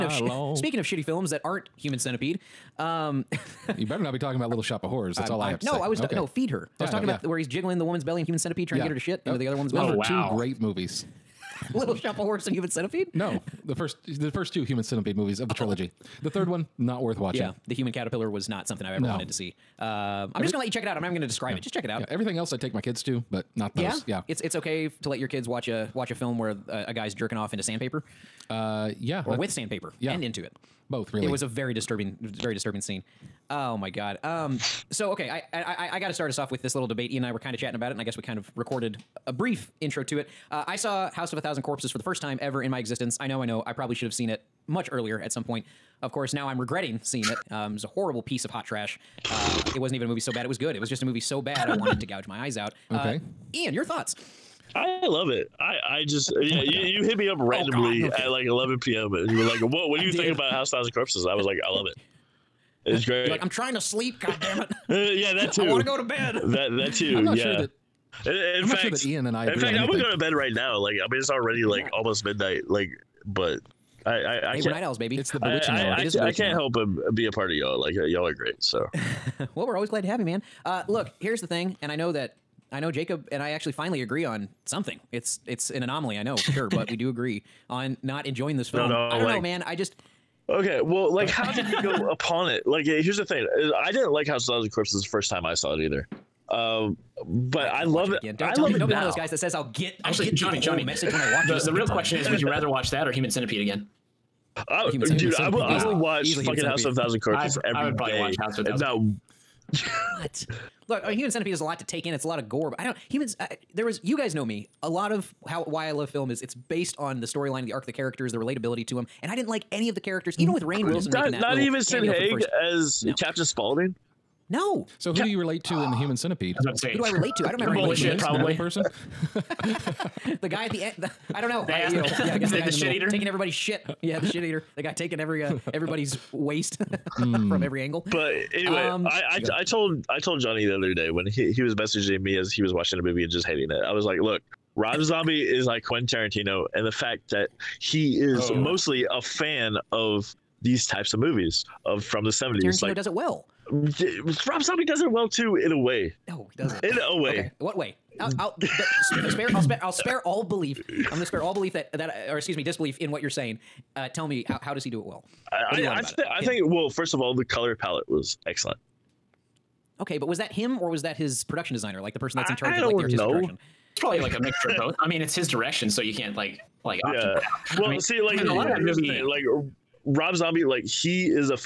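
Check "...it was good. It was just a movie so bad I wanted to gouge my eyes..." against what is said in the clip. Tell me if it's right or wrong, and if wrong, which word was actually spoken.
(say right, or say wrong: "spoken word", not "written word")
right.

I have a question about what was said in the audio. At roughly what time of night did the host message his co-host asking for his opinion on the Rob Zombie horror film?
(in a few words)
11 p.m.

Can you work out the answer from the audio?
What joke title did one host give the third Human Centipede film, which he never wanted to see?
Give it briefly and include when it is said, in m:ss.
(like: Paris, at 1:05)
The Human Caterpillar, at 0:17.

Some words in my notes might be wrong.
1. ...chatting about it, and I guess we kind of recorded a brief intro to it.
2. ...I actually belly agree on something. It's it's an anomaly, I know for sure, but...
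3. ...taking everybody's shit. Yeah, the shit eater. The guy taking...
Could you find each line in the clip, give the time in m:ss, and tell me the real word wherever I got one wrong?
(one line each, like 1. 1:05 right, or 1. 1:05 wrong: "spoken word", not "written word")
1. 0:37 right
2. 1:23 wrong: "finally", not "belly"
3. 2:13 right.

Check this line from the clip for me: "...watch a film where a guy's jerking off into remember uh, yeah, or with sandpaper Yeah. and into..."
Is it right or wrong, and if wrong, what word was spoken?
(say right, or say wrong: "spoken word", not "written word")
wrong: "sandpaper", not "remember".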